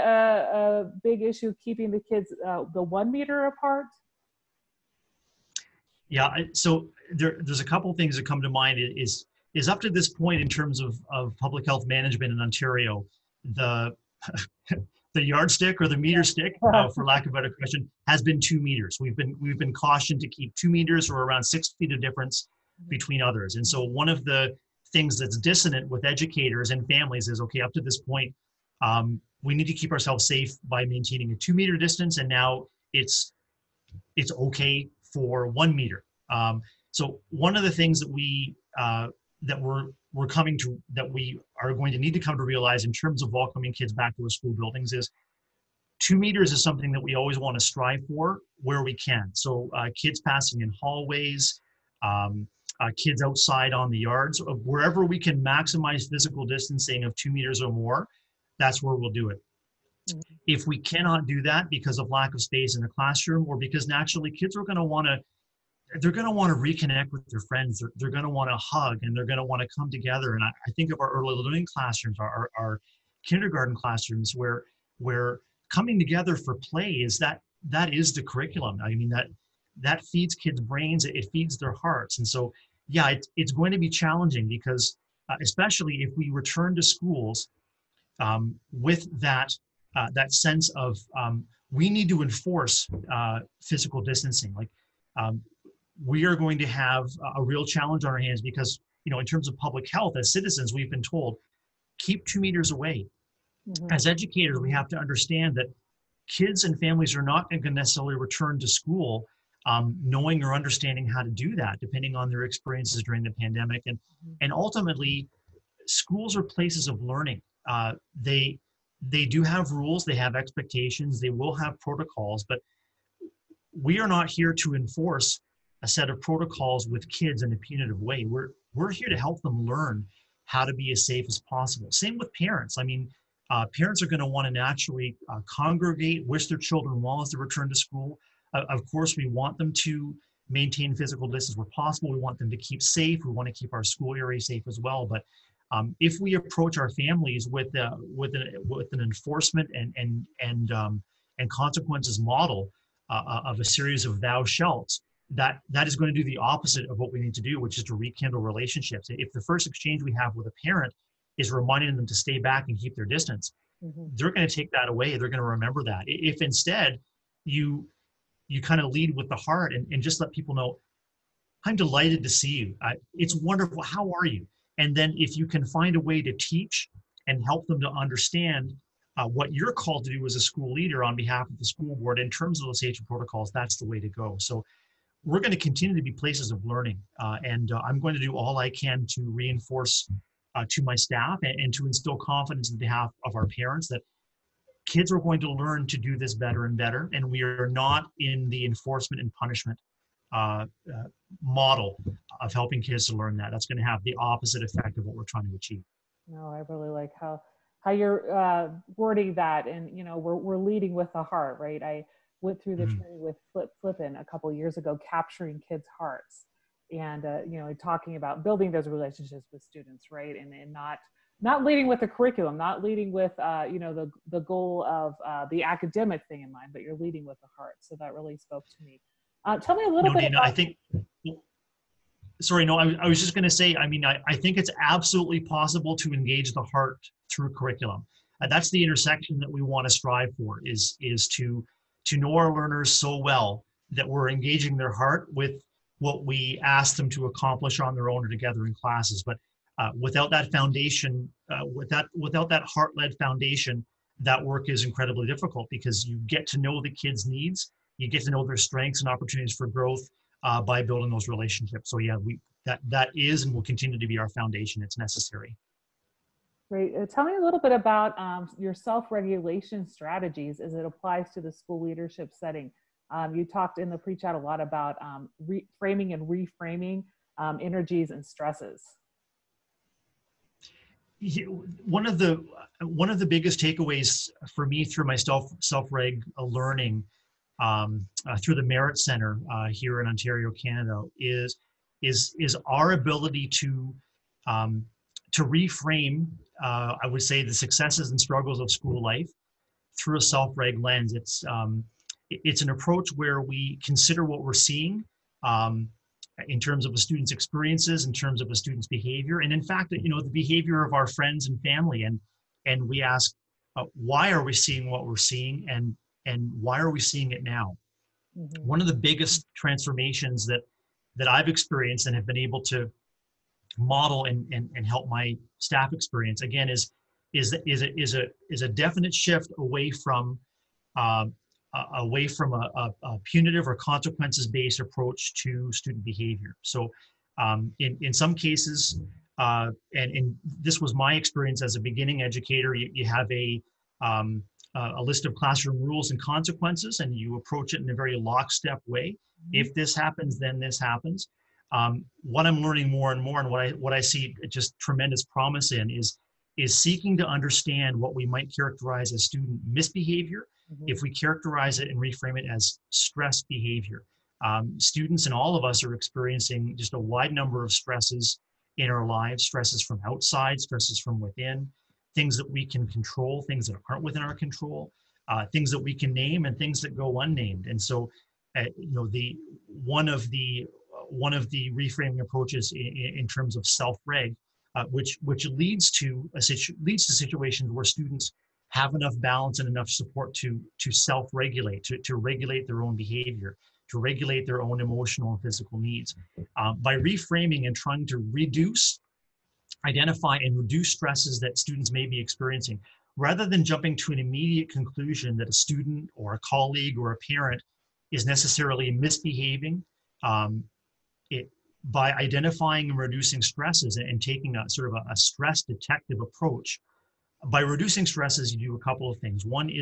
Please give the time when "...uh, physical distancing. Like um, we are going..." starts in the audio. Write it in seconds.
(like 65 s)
93 s.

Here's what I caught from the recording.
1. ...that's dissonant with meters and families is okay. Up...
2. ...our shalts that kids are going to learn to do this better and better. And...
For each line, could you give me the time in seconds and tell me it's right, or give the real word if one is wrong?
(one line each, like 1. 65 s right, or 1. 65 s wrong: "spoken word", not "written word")
1. 25 s wrong: "educators", not "meters"
2. 193 s wrong: "parents", not "shalts".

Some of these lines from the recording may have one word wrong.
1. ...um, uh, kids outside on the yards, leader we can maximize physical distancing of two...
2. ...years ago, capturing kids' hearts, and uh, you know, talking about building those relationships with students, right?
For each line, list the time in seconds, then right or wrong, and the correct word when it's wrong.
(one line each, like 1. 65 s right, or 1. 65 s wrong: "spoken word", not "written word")
1. 52 s wrong: "wherever", not "leader"
2. 214 s right.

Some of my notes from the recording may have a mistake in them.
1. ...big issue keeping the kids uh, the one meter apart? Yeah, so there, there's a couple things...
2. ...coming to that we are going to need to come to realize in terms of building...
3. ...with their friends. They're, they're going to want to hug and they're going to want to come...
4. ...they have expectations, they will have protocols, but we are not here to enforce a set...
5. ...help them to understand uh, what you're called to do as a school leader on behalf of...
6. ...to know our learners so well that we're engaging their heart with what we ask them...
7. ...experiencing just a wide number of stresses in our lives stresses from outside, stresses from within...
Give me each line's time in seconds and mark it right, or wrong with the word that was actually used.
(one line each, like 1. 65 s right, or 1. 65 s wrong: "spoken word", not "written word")
1. 1 s right
2. 40 s wrong: "welcoming", not "building"
3. 67 s right
4. 120 s right
5. 177 s right
6. 242 s right
7. 365 s right.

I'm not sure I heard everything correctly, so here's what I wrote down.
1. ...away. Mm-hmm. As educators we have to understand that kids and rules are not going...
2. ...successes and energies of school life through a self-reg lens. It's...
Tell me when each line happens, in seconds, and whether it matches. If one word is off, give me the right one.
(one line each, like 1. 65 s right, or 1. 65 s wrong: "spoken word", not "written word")
1. 102 s wrong: "families", not "rules"
2. 297 s wrong: "struggles", not "energies".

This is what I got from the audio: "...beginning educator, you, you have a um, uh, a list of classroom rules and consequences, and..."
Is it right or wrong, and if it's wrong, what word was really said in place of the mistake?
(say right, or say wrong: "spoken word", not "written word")
right.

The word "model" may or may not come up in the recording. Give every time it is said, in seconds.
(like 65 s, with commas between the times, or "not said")
152 s, 201 s, 323 s.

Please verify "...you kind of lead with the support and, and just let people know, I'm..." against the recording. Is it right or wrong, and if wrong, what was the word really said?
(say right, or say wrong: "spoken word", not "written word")
wrong: "heart", not "support".